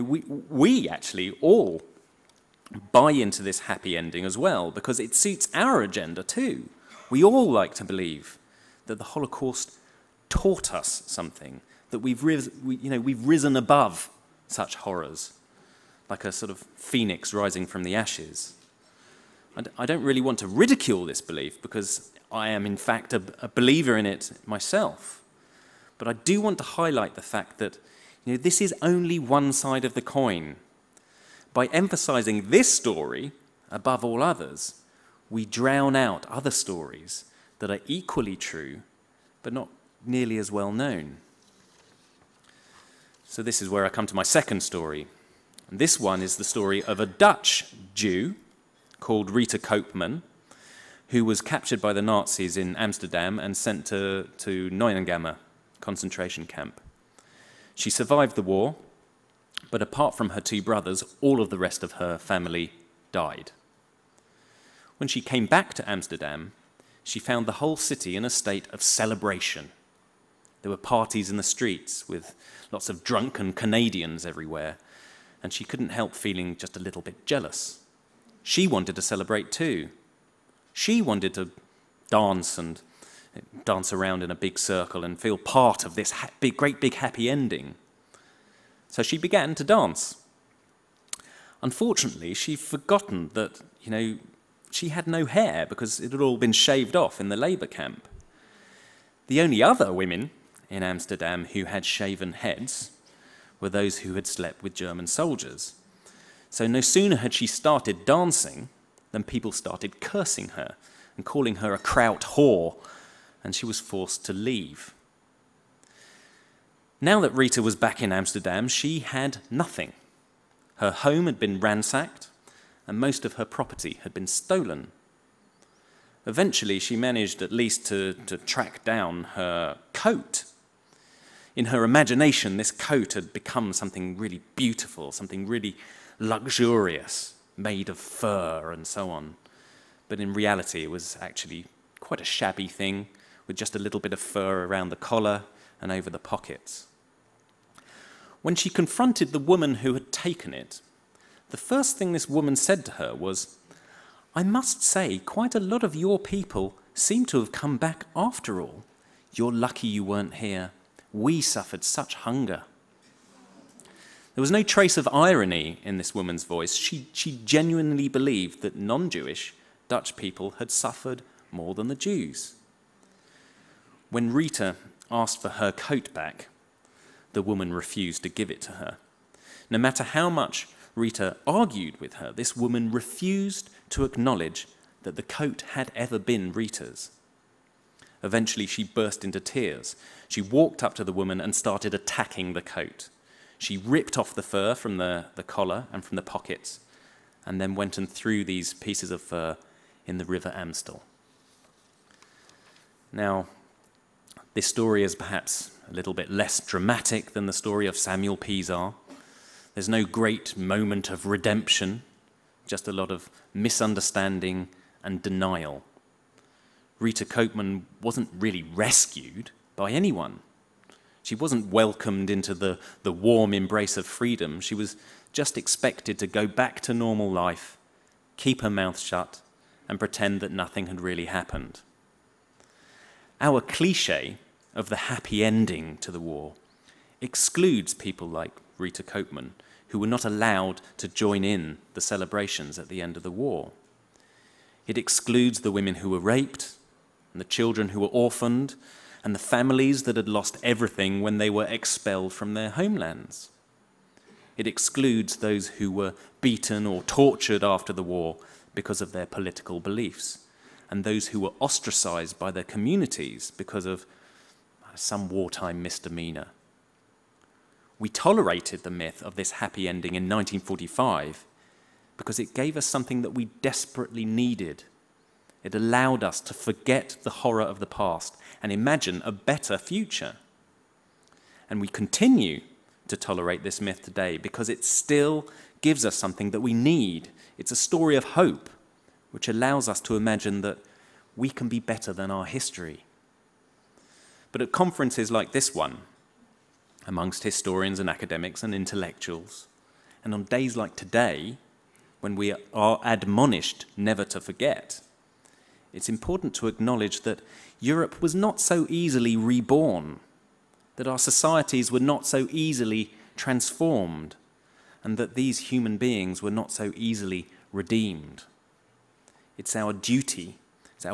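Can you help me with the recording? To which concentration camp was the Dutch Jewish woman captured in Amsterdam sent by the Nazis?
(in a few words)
Neuengamme.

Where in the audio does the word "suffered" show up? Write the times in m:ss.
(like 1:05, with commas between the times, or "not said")
2:41, 2:50.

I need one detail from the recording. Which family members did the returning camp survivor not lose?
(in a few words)
her two brothers.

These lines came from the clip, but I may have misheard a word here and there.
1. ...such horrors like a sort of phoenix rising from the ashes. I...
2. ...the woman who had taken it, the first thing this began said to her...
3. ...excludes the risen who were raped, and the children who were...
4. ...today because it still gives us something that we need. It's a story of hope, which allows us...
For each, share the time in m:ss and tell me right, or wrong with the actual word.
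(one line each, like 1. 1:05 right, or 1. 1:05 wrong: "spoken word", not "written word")
1. 0:14 right
2. 2:29 wrong: "woman", not "began"
3. 4:04 wrong: "women", not "risen"
4. 4:44 right.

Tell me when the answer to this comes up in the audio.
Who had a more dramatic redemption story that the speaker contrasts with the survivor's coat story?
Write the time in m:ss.
3:27.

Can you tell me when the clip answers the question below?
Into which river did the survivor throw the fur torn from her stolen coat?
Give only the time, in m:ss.
3:20.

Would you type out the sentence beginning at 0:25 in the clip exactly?
But I do want to highlight the fact that you know, this is only one side of the coin.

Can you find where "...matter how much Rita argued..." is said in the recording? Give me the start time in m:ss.
2:59.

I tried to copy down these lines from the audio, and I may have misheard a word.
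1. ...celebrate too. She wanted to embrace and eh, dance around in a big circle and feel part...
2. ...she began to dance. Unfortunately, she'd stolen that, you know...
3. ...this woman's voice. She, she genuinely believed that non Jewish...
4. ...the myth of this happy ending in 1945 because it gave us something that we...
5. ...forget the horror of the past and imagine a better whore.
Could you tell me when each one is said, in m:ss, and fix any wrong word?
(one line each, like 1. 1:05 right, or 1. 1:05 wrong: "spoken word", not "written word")
1. 1:19 wrong: "dance", not "embrace"
2. 1:29 wrong: "forgotten", not "stolen"
3. 2:45 right
4. 4:28 right
5. 4:36 wrong: "future", not "whore".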